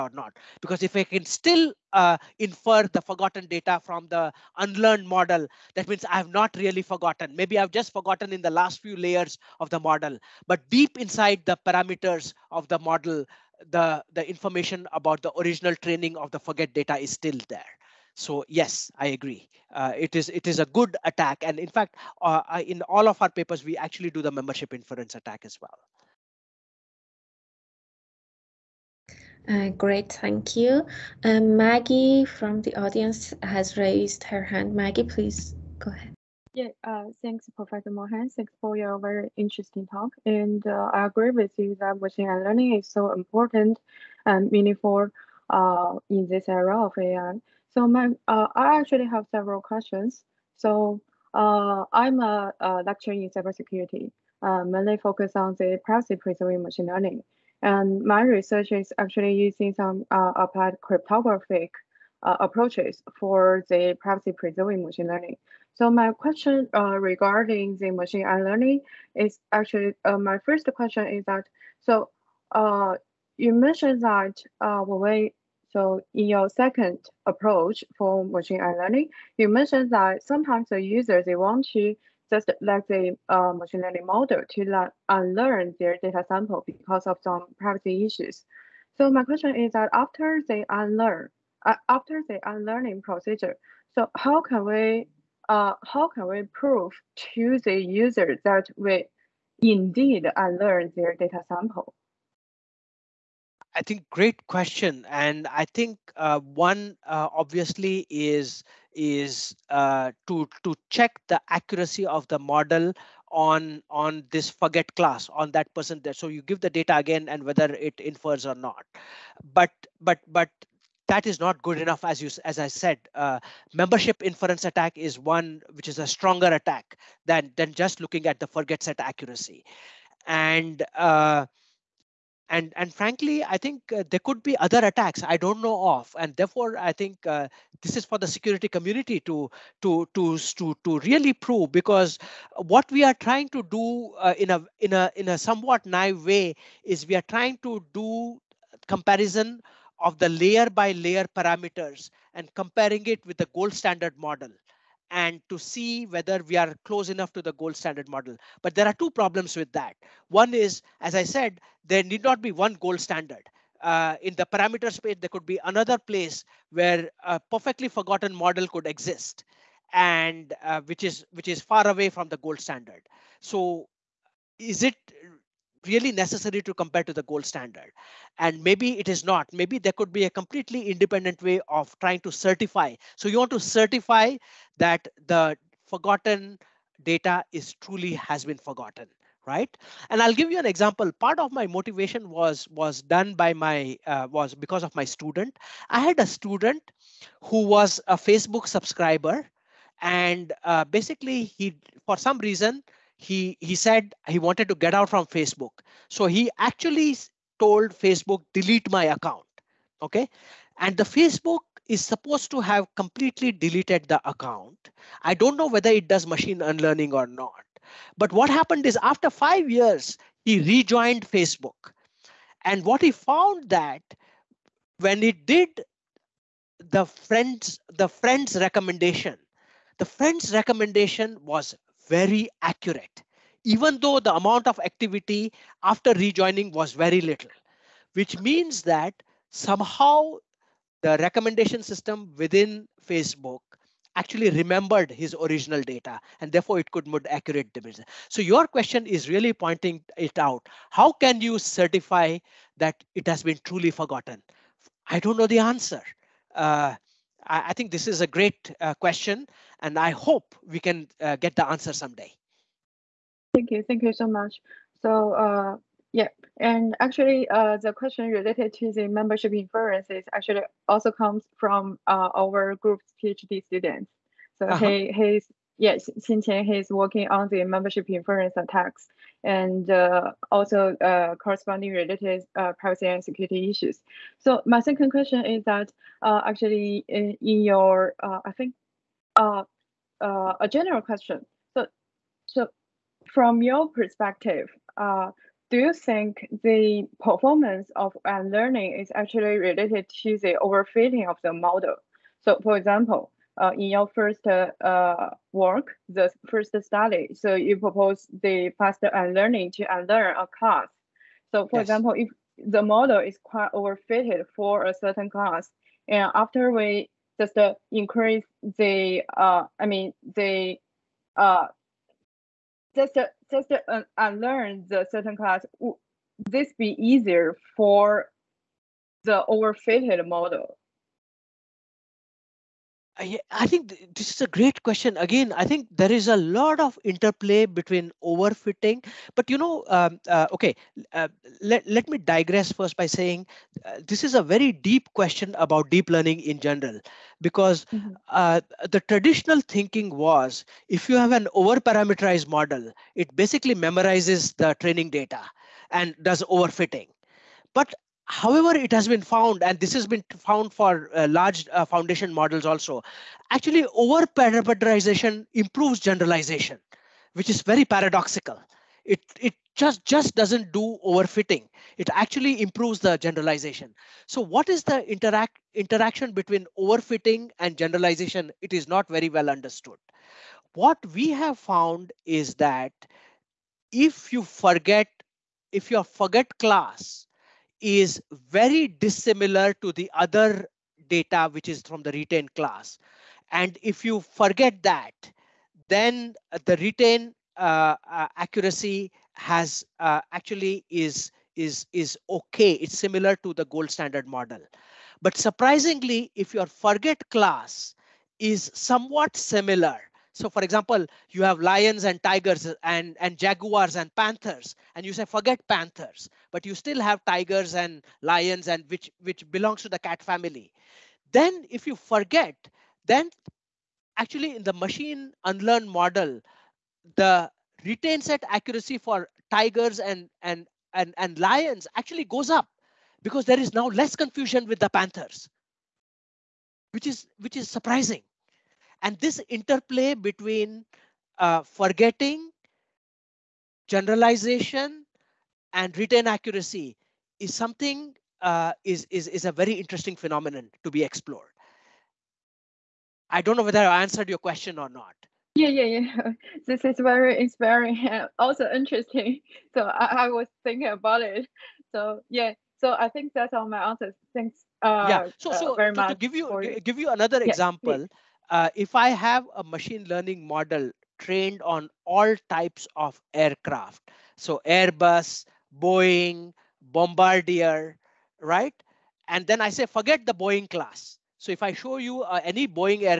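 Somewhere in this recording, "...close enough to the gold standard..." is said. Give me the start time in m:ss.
2:36.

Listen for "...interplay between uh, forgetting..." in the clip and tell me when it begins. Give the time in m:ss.
7:19.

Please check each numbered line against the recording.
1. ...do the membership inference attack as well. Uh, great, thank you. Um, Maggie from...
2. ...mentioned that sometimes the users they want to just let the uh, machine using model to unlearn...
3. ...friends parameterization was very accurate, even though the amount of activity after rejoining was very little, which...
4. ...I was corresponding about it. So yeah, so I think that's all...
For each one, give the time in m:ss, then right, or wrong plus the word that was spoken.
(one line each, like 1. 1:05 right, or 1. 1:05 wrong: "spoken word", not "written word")
1. 0:24 right
2. 1:19 wrong: "learning", not "using"
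3. 3:50 wrong: "recommendation", not "parameterization"
4. 7:40 wrong: "thinking", not "corresponding".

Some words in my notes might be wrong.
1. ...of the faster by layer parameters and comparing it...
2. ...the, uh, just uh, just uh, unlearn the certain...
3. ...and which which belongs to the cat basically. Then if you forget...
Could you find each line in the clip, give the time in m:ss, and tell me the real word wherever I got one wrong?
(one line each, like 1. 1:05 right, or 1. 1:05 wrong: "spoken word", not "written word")
1. 2:30 wrong: "layer", not "faster"
2. 5:20 right
3. 6:58 wrong: "family", not "basically".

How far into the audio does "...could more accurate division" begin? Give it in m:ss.
4:06.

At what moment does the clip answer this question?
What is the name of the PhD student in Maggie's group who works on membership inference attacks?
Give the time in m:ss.
4:36.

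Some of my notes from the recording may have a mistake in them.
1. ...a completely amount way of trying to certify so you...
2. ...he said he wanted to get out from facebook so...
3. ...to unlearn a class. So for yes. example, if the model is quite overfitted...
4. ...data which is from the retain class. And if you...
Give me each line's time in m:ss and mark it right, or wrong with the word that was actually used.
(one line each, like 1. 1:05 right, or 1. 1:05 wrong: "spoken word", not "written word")
1. 3:00 wrong: "independent", not "amount"
2. 3:23 right
3. 5:09 right
4. 6:31 right.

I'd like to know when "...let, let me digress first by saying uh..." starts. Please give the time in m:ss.
5:41.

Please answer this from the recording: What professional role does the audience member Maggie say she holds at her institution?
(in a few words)
Lecturer in cybersecurity.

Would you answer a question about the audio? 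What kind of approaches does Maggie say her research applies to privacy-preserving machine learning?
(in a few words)
Applied cryptographic.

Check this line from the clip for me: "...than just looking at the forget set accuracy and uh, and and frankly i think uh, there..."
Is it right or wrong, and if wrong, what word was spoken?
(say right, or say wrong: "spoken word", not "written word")
right.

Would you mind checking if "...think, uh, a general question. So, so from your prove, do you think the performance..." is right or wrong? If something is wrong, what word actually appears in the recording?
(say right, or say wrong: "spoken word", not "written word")
wrong: "perspective", not "prove".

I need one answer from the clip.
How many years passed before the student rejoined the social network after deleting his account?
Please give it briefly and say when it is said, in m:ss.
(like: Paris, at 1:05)
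5, at 3:39.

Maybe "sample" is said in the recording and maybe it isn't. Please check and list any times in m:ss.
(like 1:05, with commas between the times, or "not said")
1:26, 1:41.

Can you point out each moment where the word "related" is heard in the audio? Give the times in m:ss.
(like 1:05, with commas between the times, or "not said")
4:28, 4:41, 4:59.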